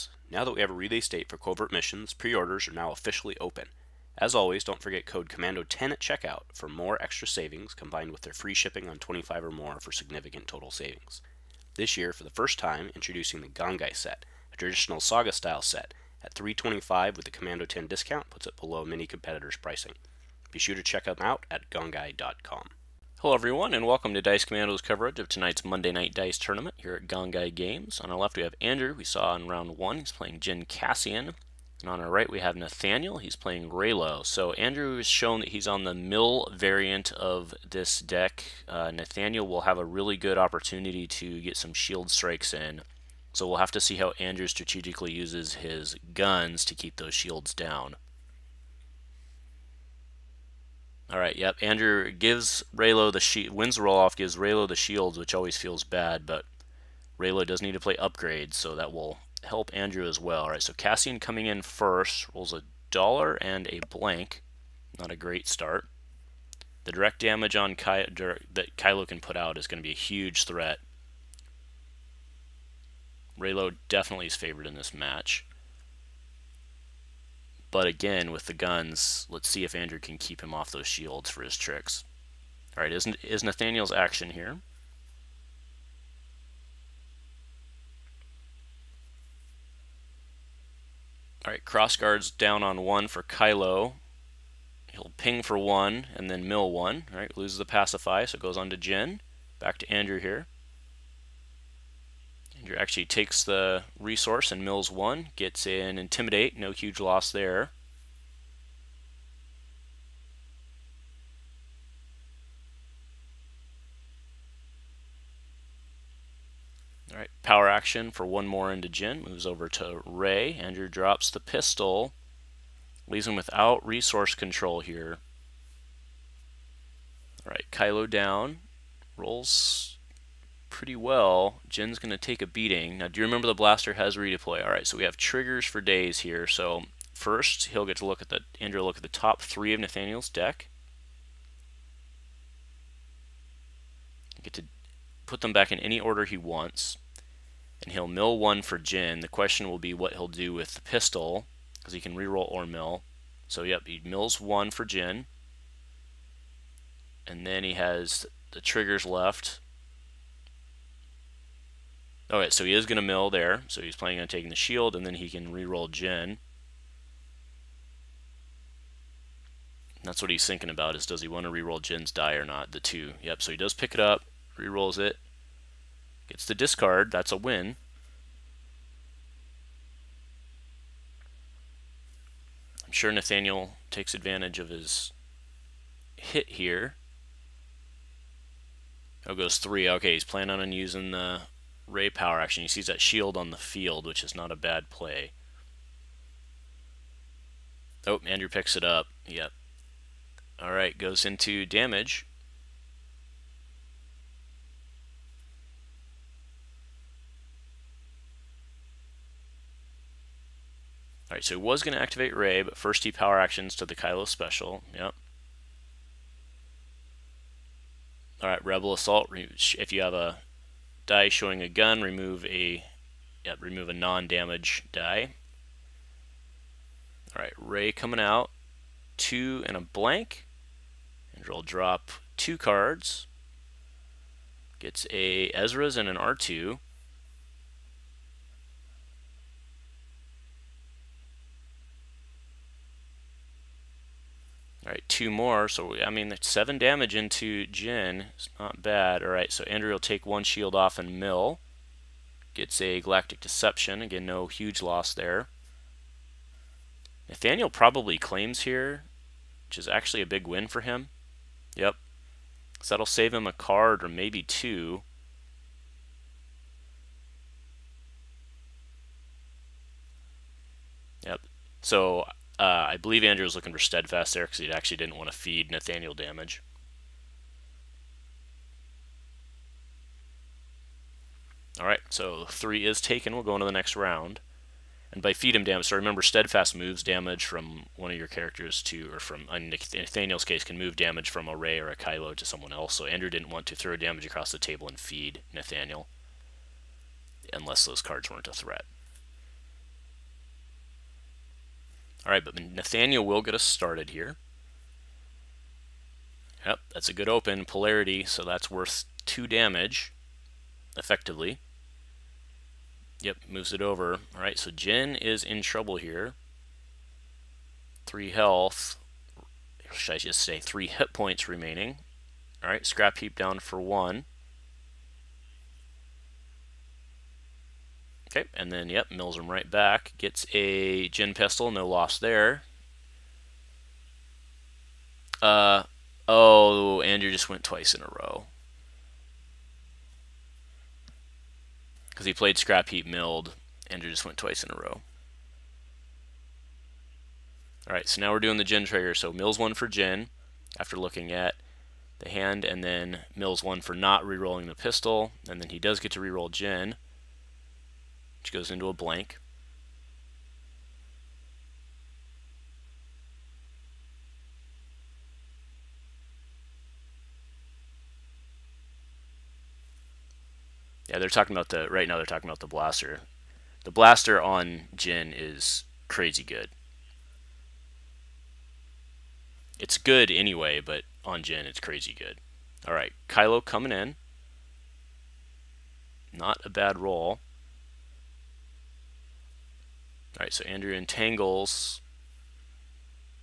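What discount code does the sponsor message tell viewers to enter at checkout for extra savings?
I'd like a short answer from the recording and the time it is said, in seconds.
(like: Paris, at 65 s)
COMMANDO10, at 5 s.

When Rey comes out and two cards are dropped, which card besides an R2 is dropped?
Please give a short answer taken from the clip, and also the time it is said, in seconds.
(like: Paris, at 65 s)
Ezra's, at 235 s.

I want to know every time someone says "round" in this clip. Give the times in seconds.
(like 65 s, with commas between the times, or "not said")
29 s, 283 s.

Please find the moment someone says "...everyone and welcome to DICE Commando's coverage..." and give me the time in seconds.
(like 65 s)
23 s.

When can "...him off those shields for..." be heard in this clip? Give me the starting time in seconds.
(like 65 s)
80 s.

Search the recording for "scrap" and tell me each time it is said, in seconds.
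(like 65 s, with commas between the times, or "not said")
322 s, 342 s.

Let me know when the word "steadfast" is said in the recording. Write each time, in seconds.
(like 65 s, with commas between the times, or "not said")
273 s, 286 s.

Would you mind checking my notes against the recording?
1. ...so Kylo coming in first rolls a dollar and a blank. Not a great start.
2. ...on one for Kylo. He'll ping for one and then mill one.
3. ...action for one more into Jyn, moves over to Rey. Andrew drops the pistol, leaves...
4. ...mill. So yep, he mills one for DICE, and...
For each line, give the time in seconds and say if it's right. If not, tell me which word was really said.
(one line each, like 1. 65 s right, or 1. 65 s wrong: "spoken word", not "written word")
1. 60 s wrong: "Cassian", not "Kylo"
2. 92 s right
3. 117 s right
4. 152 s wrong: "Jyn", not "DICE".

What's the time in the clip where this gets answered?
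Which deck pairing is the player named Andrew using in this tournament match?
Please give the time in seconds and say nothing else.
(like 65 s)
30 s.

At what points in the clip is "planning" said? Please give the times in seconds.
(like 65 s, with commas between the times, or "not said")
163 s, 190 s.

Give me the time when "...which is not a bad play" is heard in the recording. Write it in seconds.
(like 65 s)
194 s.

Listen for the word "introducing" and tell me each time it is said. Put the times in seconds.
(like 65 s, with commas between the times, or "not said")
12 s.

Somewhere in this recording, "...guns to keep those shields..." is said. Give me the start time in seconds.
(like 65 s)
46 s.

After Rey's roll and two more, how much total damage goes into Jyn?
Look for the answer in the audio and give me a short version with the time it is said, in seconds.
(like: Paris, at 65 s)
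7, at 246 s.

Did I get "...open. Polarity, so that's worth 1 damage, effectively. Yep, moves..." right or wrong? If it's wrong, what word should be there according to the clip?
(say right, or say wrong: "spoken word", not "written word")
wrong: "2", not "1".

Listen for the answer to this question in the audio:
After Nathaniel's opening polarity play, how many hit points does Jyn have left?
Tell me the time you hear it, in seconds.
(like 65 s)
320 s.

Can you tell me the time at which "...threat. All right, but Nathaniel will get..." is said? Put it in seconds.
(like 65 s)
298 s.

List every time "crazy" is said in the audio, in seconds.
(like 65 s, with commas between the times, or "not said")
376 s, 381 s.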